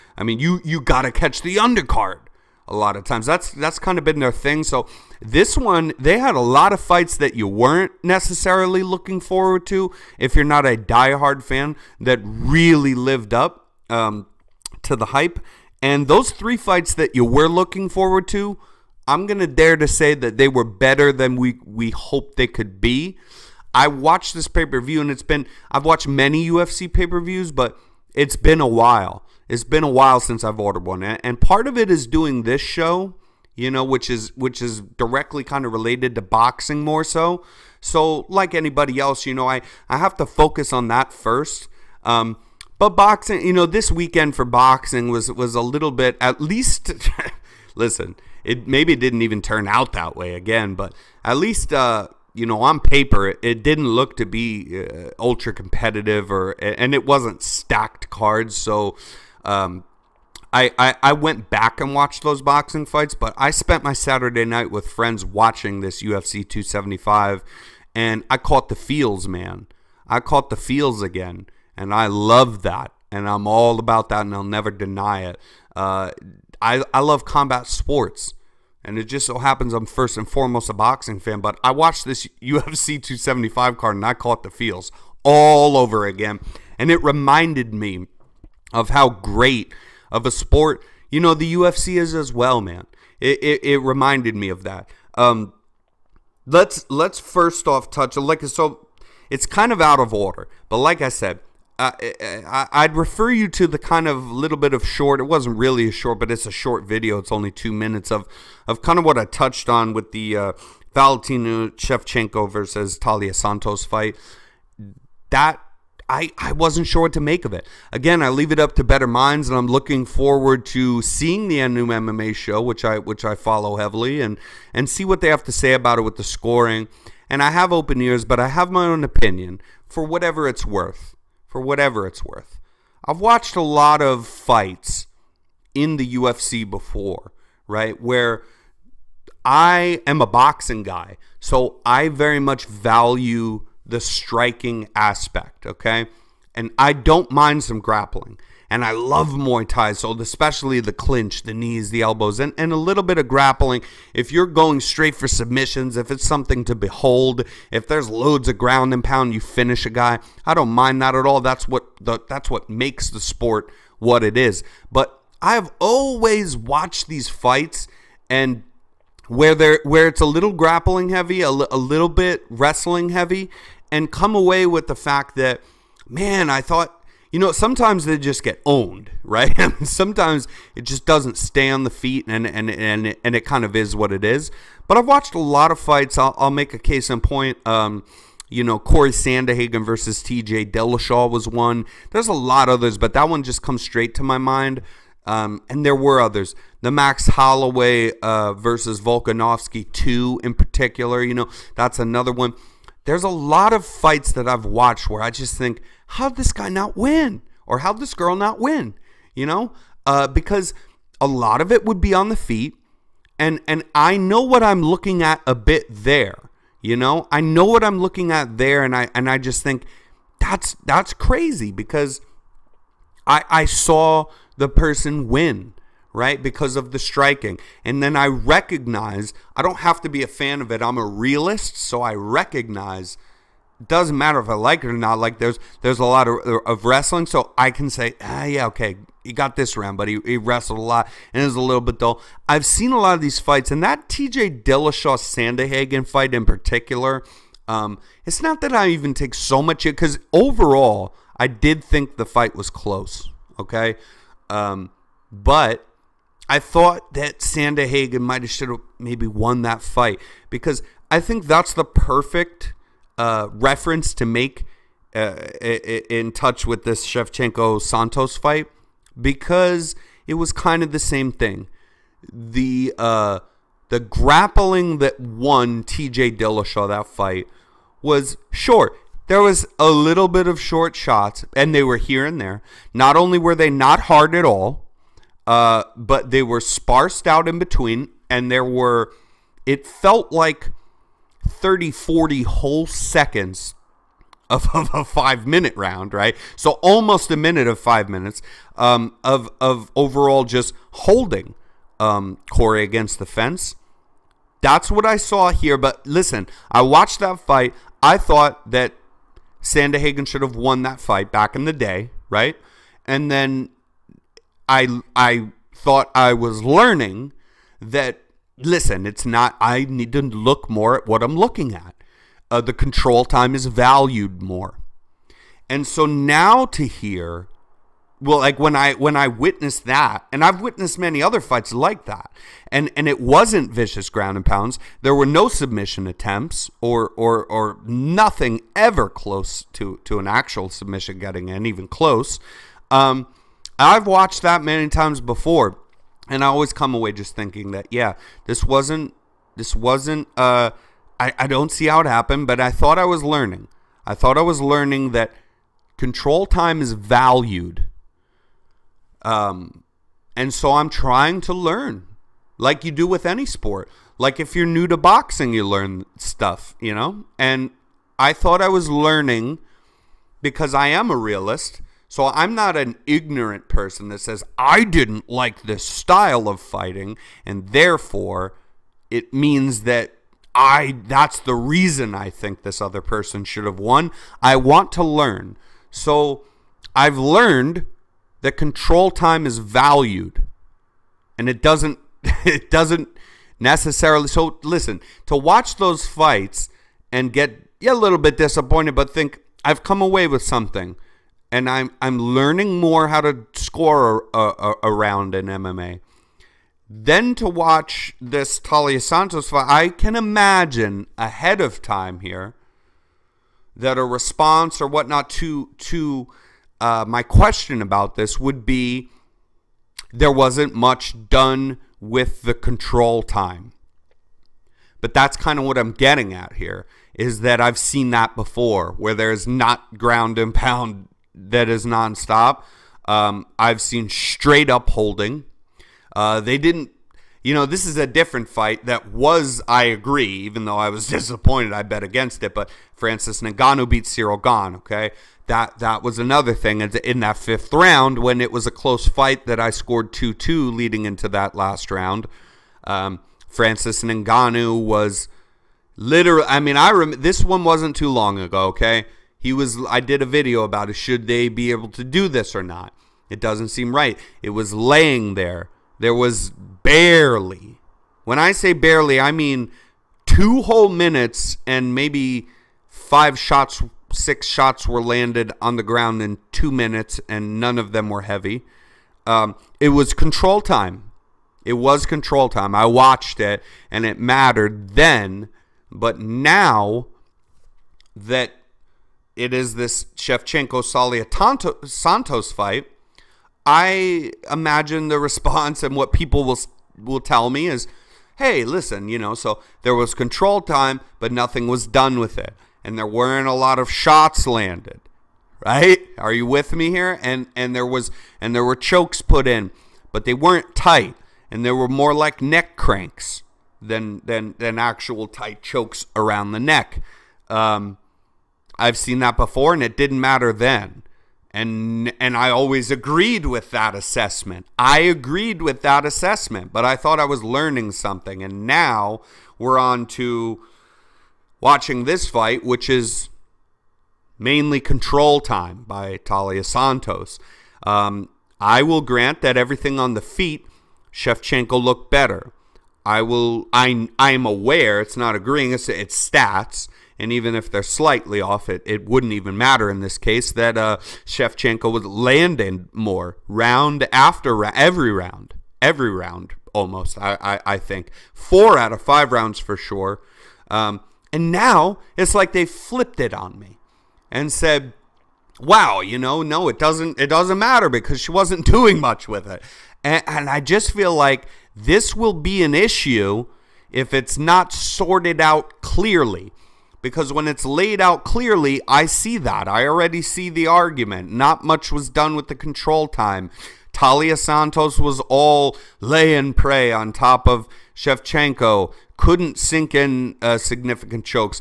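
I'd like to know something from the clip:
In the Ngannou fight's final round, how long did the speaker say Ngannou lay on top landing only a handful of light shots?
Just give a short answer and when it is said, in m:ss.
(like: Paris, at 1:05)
2 minutes, at 7:50.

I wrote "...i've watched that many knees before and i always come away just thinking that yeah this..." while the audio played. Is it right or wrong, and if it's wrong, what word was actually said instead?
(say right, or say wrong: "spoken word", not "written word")
wrong: "times", not "knees".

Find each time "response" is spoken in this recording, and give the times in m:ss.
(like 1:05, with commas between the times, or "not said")
6:54, 8:15.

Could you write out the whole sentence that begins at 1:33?
It it, it reminded me of that.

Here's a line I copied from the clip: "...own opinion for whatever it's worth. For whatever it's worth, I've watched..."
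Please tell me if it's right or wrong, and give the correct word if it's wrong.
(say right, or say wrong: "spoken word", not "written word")
right.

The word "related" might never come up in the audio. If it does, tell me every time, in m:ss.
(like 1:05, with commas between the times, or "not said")
0:35.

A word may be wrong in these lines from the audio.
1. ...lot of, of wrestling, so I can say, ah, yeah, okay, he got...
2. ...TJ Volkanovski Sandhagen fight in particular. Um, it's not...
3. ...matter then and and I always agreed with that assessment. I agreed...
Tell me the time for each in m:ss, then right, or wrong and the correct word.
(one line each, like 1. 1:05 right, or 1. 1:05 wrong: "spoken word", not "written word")
1. 3:56 right
2. 4:04 wrong: "Dillashaw", not "Volkanovski"
3. 8:40 right.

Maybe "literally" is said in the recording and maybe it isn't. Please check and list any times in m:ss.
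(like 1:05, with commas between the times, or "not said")
7:35.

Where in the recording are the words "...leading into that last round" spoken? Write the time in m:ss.
7:30.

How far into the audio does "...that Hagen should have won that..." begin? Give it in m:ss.
5:08.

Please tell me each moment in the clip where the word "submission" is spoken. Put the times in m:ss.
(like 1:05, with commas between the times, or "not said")
2:35, 5:35, 5:40.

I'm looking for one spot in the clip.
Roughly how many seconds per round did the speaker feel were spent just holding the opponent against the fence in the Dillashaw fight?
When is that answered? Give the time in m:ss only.
4:51.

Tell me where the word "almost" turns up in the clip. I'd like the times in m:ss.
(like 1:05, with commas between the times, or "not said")
4:56, 9:16.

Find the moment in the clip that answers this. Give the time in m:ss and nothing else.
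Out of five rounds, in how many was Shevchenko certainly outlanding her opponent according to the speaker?
9:18.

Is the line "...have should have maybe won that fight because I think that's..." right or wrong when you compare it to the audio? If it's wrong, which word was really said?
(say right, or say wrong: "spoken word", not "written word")
right.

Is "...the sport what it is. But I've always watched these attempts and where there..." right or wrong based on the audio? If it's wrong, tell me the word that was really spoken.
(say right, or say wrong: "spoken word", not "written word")
wrong: "fights", not "attempts".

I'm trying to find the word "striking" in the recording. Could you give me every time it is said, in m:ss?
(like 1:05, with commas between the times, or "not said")
2:24, 3:46.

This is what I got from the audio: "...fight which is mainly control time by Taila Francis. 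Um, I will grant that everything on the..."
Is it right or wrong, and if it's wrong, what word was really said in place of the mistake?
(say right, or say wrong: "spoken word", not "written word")
wrong: "Santos", not "Francis".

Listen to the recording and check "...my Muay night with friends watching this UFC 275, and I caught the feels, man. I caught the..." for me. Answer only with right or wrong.
wrong.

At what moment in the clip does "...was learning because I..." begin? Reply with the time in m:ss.
6:08.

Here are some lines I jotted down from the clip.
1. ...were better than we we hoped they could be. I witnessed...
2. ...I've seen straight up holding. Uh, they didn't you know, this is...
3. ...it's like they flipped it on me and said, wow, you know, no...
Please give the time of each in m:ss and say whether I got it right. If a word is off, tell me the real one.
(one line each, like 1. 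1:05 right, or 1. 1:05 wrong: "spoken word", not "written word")
1. 0:20 wrong: "watched", not "witnessed"
2. 7:13 right
3. 9:22 right.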